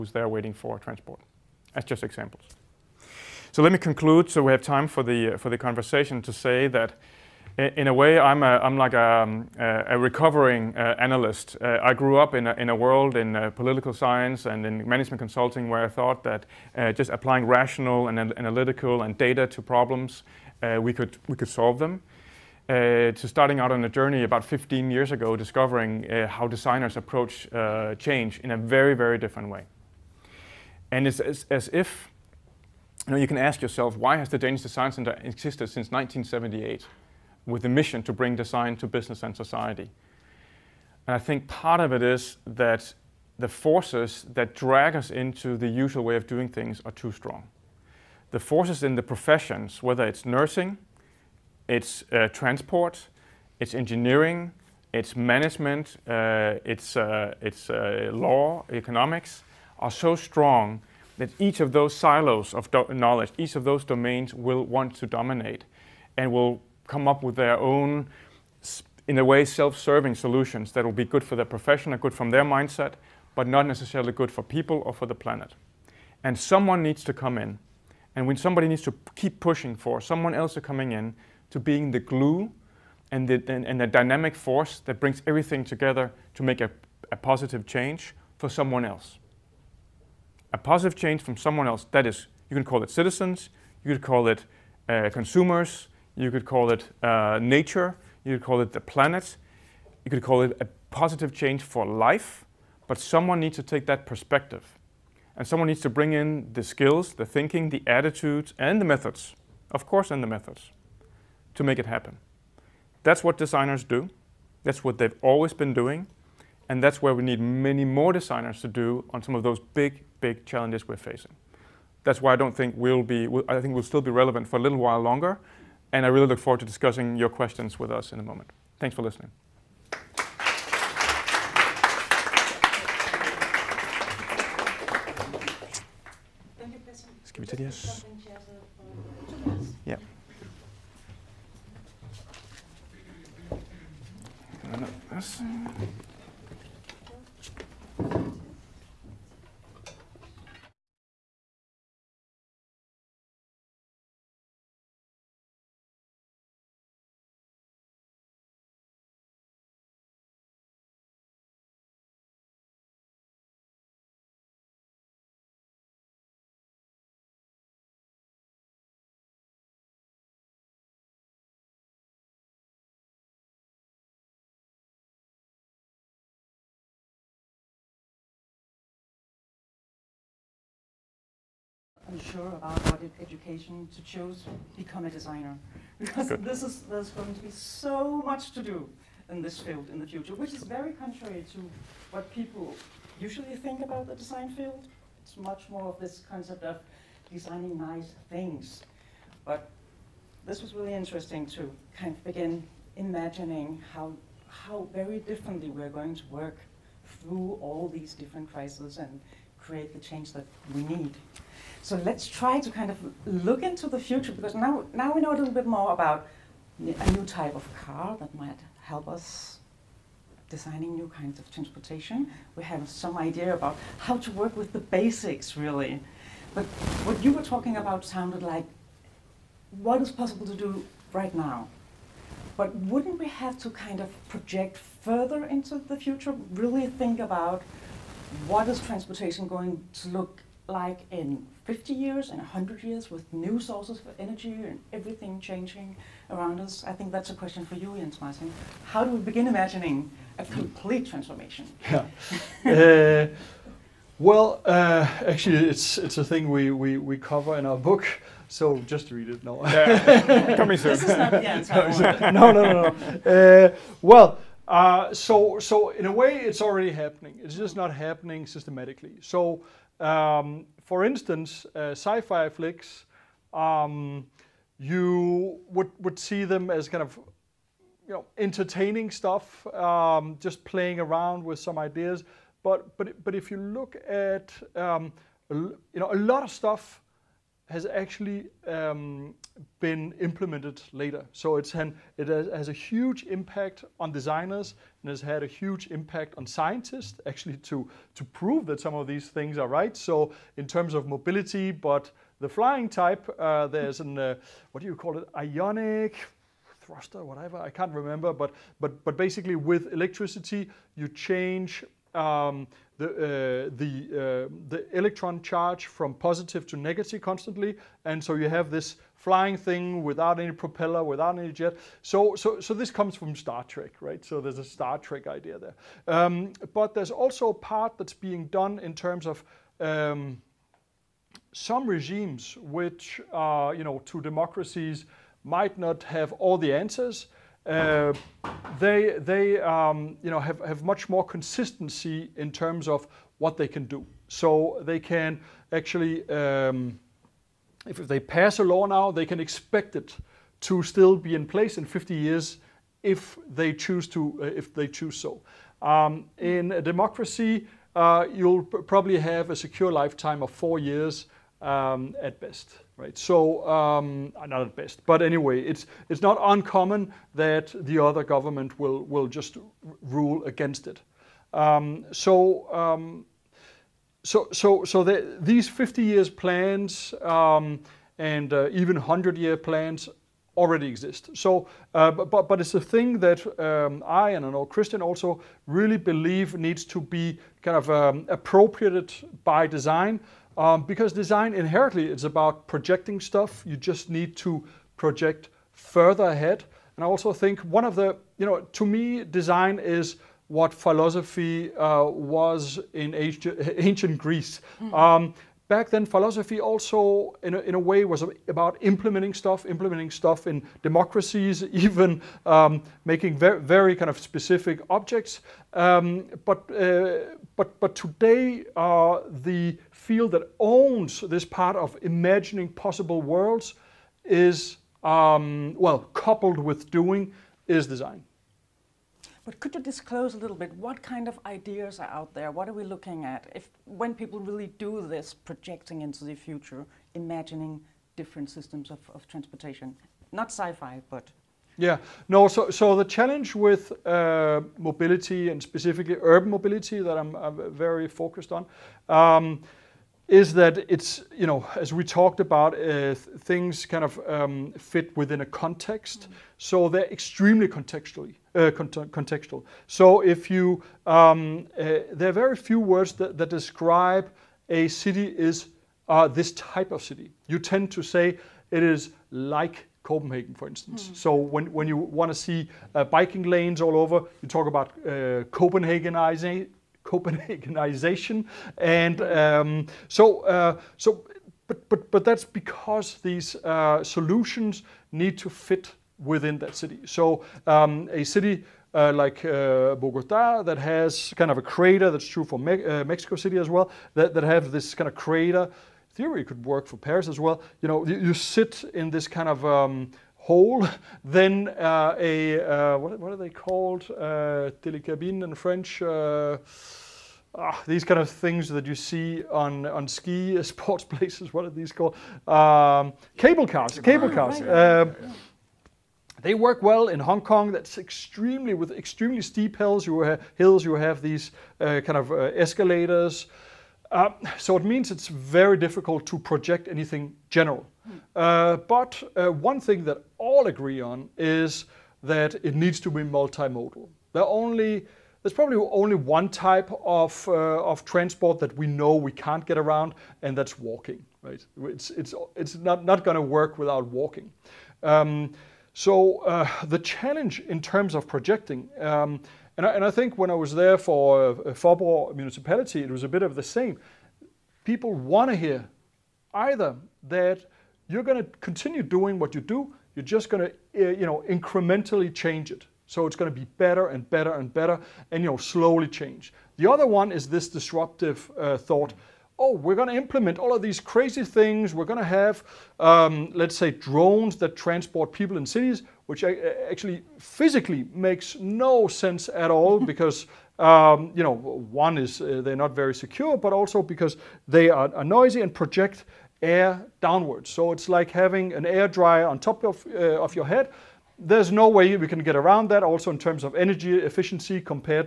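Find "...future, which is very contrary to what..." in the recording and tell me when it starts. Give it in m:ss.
3:10.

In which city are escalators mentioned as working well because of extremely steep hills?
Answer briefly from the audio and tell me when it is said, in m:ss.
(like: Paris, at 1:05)
Hong Kong, at 8:37.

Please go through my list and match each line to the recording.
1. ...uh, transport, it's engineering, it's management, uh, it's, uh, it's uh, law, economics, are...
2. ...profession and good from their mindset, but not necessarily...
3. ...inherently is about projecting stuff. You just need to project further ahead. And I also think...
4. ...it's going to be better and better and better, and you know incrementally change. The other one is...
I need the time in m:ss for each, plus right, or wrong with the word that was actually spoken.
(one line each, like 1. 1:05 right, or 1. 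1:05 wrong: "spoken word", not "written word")
1. 0:52 right
2. 1:11 right
3. 6:31 right
4. 9:23 wrong: "slowly", not "incrementally".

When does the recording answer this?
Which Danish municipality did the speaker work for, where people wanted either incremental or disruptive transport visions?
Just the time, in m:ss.
9:11.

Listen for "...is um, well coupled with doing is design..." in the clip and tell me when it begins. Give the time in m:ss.
7:04.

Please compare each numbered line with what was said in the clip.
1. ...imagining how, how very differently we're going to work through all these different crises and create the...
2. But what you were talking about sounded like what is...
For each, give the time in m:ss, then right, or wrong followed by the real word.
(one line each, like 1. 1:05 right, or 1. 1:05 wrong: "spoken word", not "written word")
1. 3:22 right
2. 3:46 right.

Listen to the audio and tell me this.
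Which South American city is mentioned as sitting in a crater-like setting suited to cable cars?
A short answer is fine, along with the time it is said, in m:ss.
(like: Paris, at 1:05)
Bogota, at 8:09.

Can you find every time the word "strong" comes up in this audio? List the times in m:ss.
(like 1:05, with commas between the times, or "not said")
0:47, 1:00.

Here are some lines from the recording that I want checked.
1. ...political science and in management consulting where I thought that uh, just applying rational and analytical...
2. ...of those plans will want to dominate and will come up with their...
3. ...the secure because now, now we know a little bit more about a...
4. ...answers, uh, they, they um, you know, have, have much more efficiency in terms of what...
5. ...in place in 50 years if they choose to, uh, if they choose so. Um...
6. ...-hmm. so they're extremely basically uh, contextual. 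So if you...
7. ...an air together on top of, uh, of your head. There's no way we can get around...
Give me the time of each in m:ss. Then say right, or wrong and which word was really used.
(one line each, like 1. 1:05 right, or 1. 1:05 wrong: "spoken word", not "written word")
1. 0:13 right
2. 1:03 wrong: "domains", not "plans"
3. 3:33 wrong: "future", not "secure"
4. 5:36 wrong: "consistency", not "efficiency"
5. 5:51 right
6. 7:36 wrong: "contextually", not "basically"
7. 9:48 wrong: "dryer", not "together".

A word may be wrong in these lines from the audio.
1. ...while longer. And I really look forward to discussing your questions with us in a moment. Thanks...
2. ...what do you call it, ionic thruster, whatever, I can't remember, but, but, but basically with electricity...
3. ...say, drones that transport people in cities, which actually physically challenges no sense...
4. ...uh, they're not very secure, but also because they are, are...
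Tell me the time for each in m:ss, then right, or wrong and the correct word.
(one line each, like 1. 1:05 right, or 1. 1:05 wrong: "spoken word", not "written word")
1. 2:04 right
2. 5:04 right
3. 9:33 wrong: "makes", not "challenges"
4. 9:42 right.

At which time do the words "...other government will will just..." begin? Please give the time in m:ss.
6:07.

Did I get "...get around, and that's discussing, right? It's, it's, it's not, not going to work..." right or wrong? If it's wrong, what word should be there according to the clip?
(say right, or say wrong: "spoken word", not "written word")
wrong: "walking", not "discussing".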